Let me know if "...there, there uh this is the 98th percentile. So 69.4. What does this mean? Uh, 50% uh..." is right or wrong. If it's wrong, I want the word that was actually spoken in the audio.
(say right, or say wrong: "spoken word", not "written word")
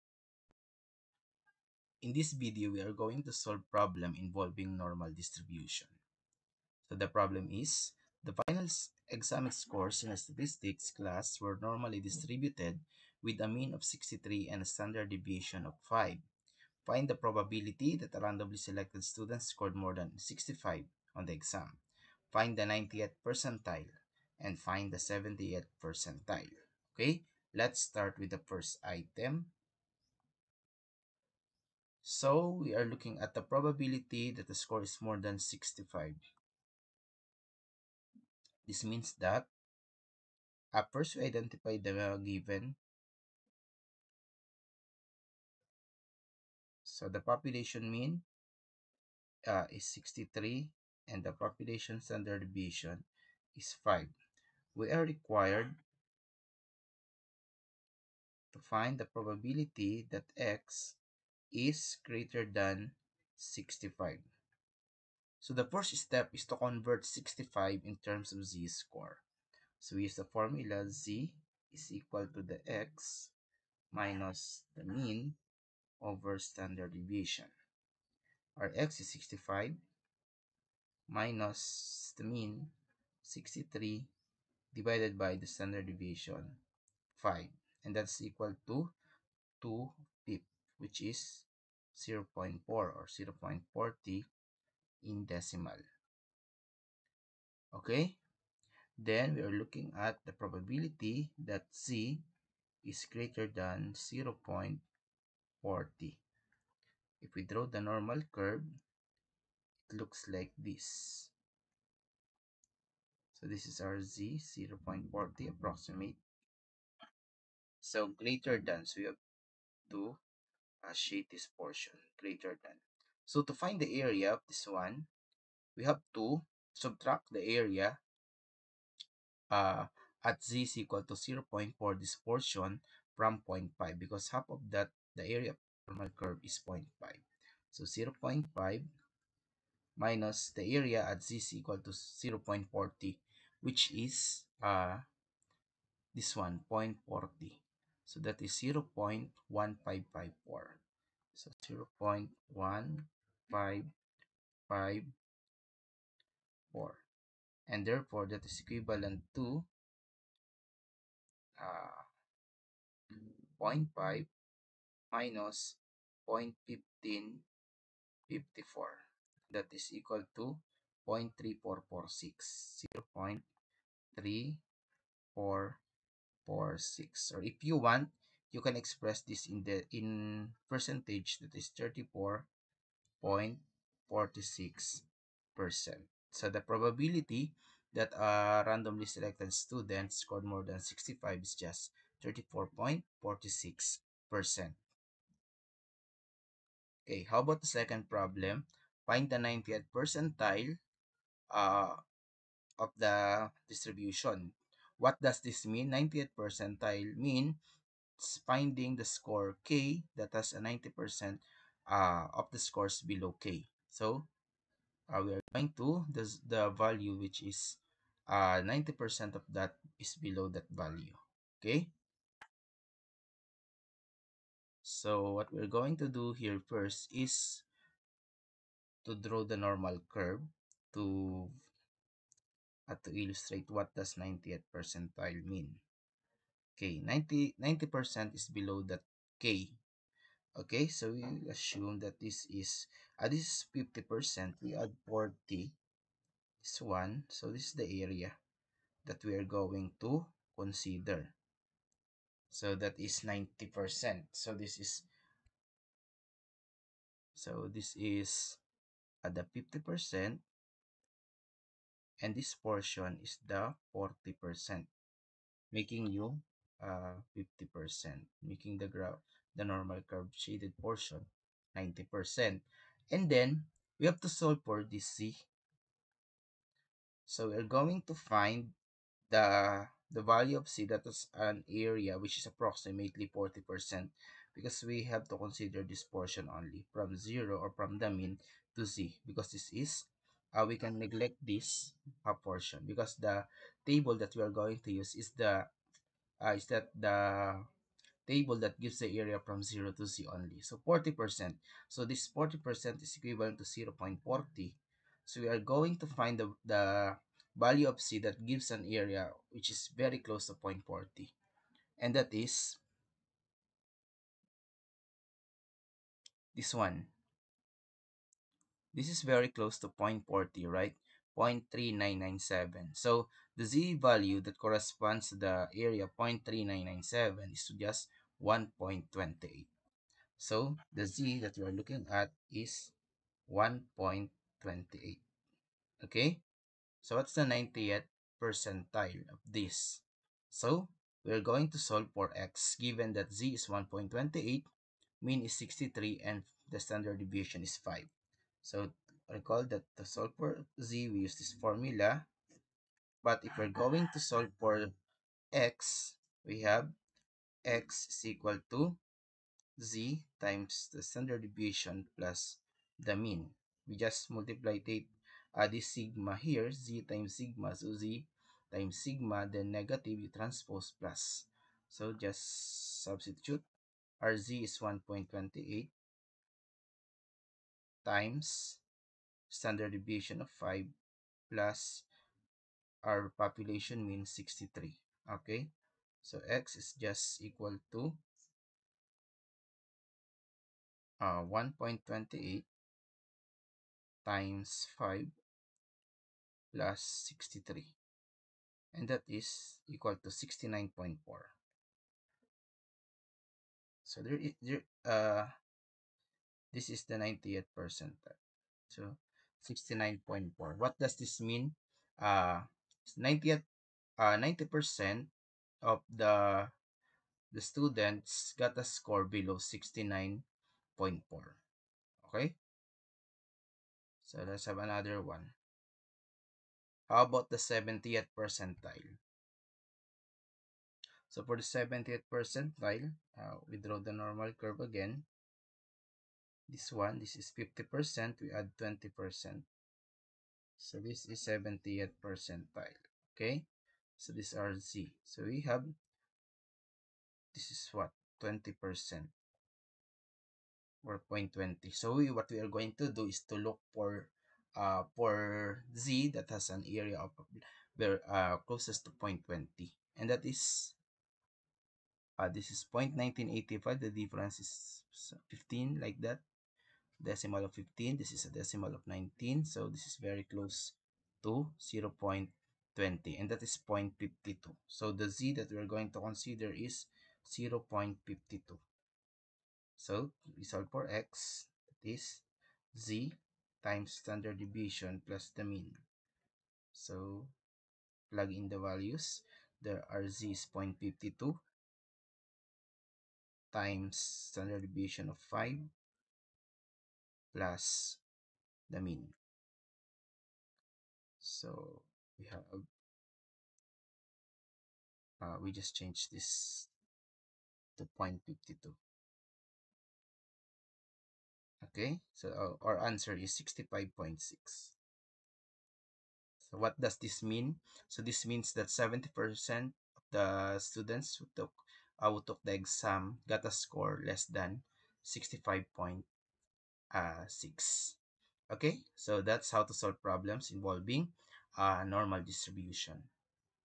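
wrong: "90", not "50".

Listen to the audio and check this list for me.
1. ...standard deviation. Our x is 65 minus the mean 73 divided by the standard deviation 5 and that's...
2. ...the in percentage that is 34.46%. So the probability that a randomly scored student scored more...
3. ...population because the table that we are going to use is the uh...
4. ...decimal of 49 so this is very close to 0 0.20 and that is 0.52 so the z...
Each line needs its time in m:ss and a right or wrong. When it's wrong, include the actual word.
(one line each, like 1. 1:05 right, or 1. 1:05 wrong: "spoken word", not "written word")
1. 1:16 wrong: "63", not "73"
2. 2:59 wrong: "selected", not "scored"
3. 4:52 wrong: "portion", not "population"
4. 7:48 wrong: "19", not "49".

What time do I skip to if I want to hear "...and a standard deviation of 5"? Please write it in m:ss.
0:14.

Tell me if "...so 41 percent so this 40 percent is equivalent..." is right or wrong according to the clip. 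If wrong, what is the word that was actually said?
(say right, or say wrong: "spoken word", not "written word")
wrong: "40", not "41".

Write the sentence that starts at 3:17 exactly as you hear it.
Okay, how about the second problem?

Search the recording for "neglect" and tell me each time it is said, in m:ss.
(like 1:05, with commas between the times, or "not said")
4:50.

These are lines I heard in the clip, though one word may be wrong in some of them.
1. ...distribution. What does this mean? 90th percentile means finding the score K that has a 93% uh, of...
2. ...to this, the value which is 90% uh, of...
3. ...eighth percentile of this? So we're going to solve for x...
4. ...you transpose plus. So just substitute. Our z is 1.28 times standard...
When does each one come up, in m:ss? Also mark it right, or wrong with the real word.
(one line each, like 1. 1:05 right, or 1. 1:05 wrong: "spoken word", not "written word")
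1. 3:23 wrong: "90", not "93"
2. 3:35 right
3. 5:37 right
4. 6:10 right.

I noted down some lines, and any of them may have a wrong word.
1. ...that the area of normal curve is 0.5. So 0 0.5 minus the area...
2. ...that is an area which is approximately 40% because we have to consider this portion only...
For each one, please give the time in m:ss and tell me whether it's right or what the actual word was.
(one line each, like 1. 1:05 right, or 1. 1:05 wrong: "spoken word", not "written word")
1. 2:14 right
2. 4:40 right.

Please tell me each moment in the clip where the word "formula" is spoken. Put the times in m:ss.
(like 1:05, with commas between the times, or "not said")
1:10, 5:51.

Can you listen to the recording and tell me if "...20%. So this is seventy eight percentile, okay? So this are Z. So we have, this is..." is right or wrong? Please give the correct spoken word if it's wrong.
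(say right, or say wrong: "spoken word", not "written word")
right.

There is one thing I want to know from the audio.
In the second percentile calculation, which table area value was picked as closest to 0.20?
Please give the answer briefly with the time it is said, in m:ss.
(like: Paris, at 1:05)
0.1985, at 7:42.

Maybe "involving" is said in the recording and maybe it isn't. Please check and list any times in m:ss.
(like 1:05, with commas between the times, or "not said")
0:04, 8:50.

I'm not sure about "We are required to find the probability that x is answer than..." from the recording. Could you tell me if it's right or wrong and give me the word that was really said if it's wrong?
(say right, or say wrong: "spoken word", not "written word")
wrong: "greater", not "answer".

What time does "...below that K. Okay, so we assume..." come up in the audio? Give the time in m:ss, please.
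3:58.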